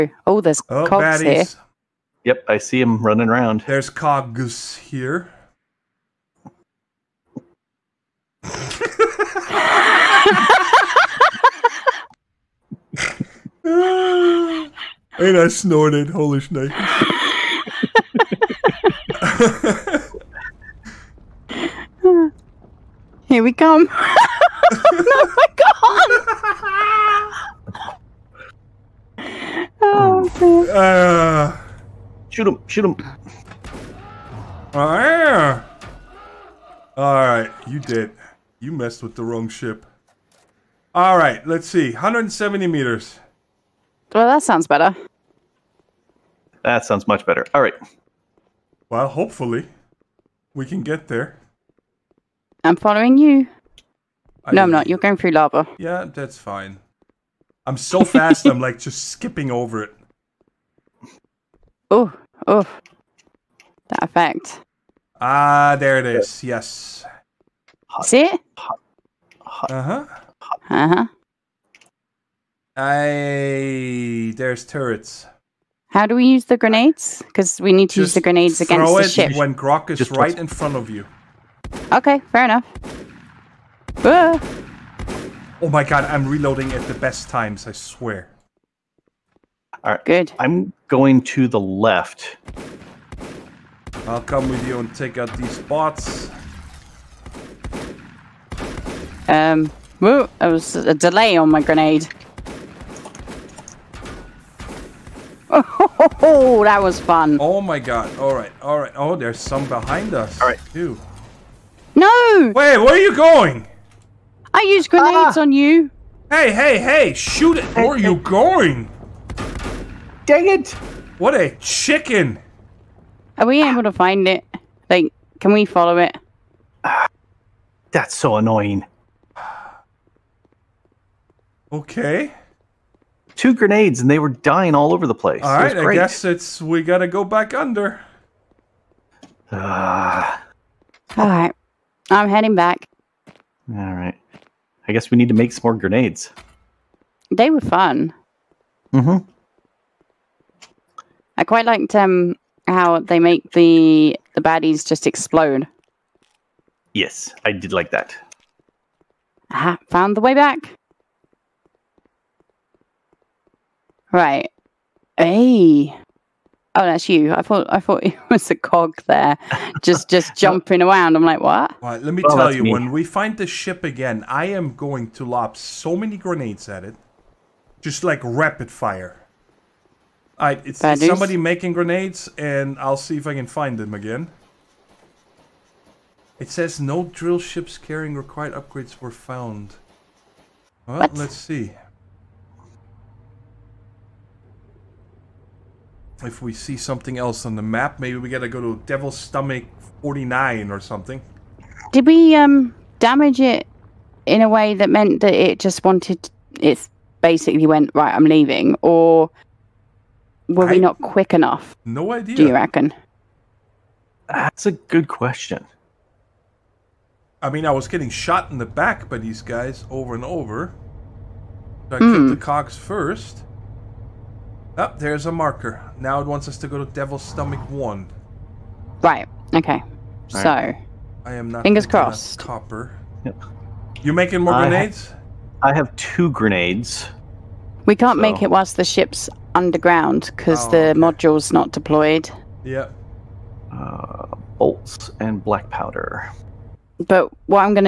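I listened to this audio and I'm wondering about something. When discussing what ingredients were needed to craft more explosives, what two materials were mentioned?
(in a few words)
bolts and black powder.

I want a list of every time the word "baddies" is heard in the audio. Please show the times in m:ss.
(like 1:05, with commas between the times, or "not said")
0:01, 2:34.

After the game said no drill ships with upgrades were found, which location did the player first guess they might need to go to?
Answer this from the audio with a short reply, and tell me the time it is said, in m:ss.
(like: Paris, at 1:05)
Devil's Stomach 49, at 3:18.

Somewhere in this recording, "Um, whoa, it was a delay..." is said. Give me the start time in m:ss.
1:39.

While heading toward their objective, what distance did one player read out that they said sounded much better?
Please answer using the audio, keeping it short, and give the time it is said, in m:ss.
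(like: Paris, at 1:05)
170 meters, at 0:41.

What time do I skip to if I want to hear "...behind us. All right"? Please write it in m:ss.
1:49.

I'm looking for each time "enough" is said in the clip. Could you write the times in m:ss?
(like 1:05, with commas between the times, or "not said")
1:22, 3:31.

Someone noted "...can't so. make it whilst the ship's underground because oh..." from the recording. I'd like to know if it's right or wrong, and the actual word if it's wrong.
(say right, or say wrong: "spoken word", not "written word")
right.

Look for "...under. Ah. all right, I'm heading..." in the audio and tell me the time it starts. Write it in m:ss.
2:17.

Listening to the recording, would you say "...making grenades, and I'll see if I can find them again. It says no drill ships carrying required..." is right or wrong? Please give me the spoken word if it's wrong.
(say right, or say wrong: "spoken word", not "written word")
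right.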